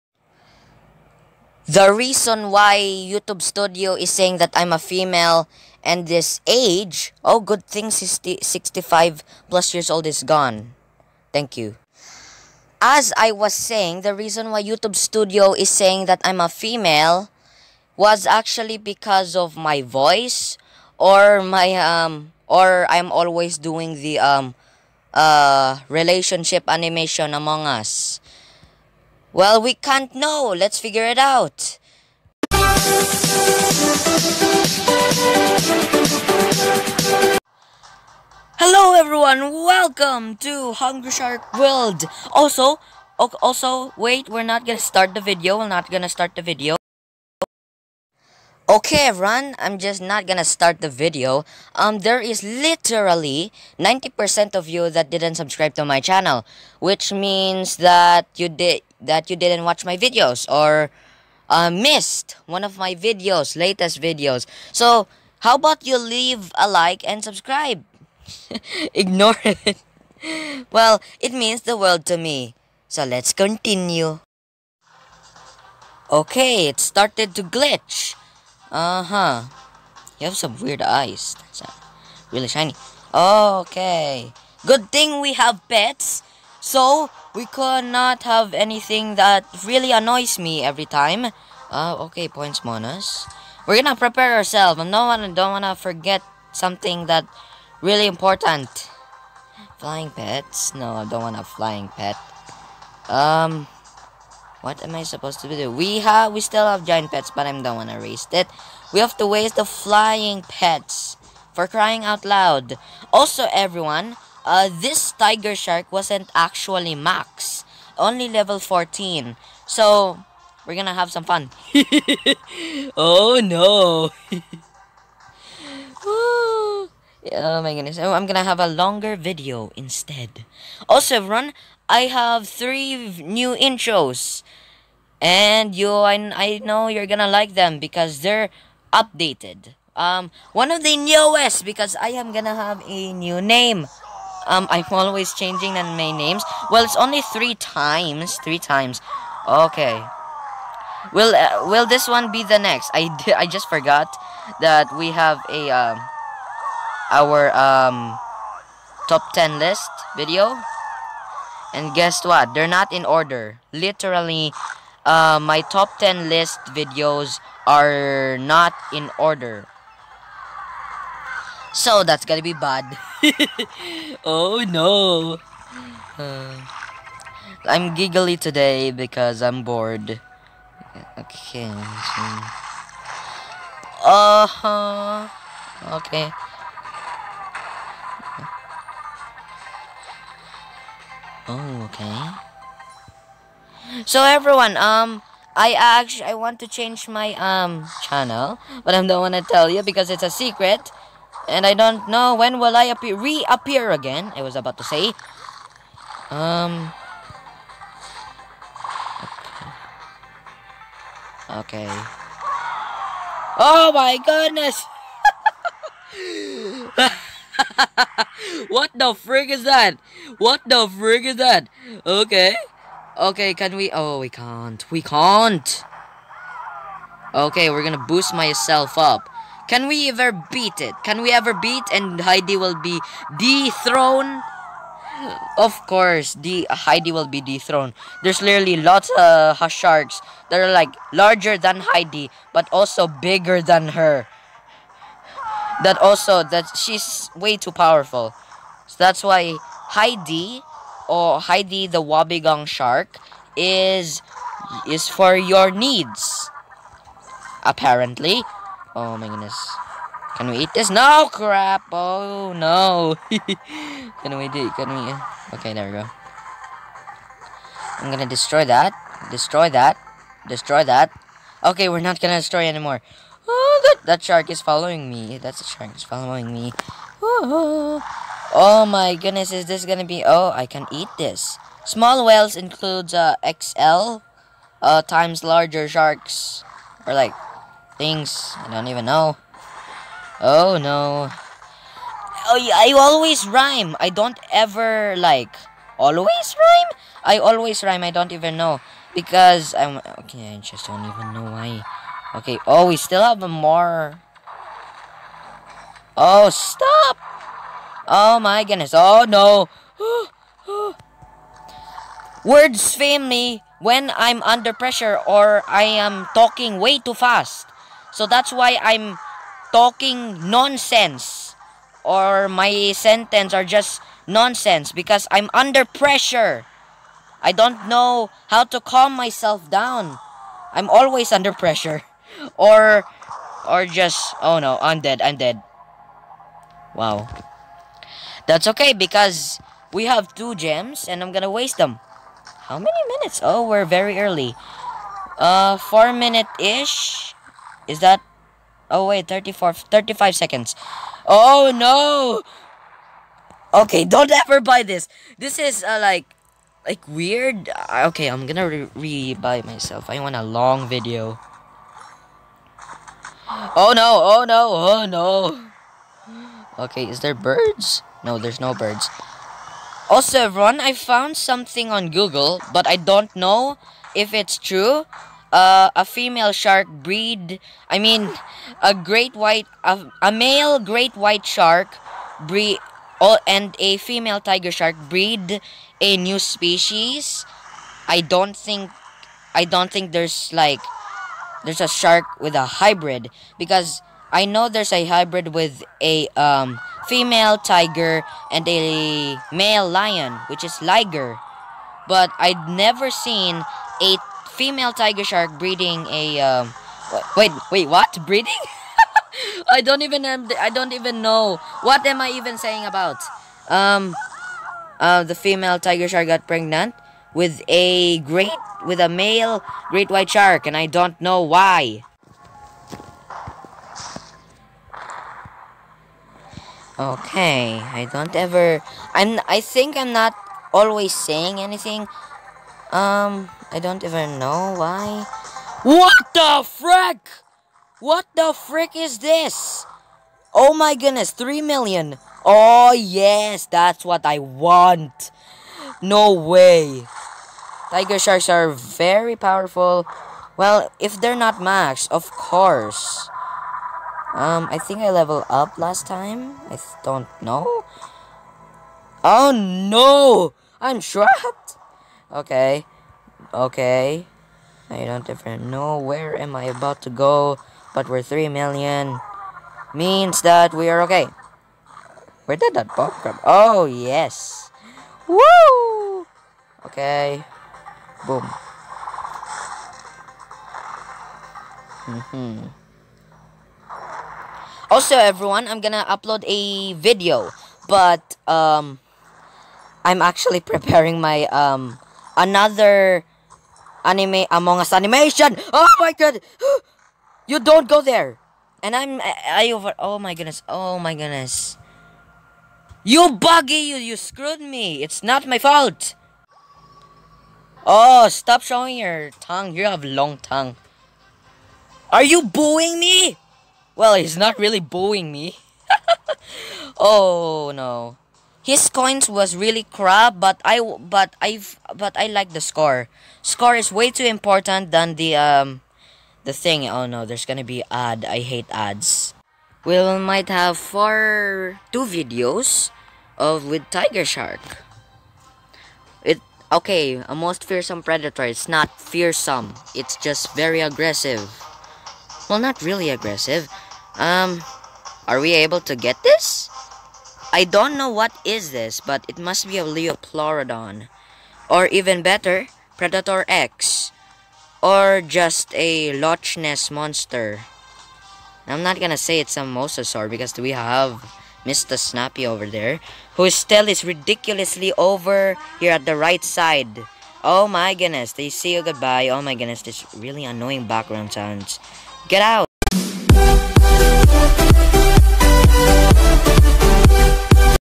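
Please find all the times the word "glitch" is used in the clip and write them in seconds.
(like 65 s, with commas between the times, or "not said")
77 s.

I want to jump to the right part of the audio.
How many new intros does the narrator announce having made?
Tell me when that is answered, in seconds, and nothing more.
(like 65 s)
132 s.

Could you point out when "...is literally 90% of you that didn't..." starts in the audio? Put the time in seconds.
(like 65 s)
52 s.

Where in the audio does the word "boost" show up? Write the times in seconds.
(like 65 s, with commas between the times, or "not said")
228 s.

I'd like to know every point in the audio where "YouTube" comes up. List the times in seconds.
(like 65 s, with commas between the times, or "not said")
2 s, 14 s.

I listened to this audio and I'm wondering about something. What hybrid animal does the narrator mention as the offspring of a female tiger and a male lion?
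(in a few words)
liger.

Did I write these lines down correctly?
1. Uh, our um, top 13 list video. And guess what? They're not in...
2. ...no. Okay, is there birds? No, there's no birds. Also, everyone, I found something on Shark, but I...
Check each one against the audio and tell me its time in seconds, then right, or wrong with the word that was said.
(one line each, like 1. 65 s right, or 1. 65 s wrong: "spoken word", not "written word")
1. 155 s wrong: "10", not "13"
2. 365 s wrong: "Google", not "Shark".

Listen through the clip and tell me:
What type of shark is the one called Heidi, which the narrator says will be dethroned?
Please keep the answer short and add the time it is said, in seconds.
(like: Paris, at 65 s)
Wobbegong, at 252 s.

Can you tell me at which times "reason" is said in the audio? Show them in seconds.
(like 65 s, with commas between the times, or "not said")
1 s, 14 s.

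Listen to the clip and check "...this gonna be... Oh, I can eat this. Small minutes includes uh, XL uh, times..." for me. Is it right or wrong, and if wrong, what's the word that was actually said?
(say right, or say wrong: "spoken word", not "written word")
wrong: "whales", not "minutes".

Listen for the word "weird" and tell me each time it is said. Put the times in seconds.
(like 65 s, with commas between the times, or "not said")
80 s, 357 s.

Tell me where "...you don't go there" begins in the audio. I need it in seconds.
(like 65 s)
497 s.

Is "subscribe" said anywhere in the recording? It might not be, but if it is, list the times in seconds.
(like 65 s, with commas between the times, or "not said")
55 s, 67 s.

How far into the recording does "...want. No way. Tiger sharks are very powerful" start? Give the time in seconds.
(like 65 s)
444 s.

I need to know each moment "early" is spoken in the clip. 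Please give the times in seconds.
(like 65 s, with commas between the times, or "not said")
344 s.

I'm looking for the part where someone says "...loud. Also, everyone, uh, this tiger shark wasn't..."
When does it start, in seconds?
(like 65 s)
112 s.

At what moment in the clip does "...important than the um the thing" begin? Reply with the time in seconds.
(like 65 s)
524 s.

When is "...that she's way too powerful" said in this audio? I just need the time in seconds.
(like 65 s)
246 s.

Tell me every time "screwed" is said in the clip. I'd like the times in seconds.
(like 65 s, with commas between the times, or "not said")
504 s.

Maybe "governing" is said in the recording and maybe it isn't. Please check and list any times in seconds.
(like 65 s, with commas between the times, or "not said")
not said.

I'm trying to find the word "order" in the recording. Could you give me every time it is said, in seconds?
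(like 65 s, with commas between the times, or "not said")
163 s, 169 s.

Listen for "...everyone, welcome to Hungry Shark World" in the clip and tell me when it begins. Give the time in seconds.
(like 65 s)
38 s.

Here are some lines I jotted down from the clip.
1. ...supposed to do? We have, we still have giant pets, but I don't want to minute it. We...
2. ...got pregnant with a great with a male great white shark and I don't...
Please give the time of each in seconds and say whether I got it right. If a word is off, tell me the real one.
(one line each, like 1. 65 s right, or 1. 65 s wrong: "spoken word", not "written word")
1. 105 s wrong: "waste", not "minute"
2. 416 s right.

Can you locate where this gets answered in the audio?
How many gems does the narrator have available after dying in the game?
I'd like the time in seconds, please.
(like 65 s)
340 s.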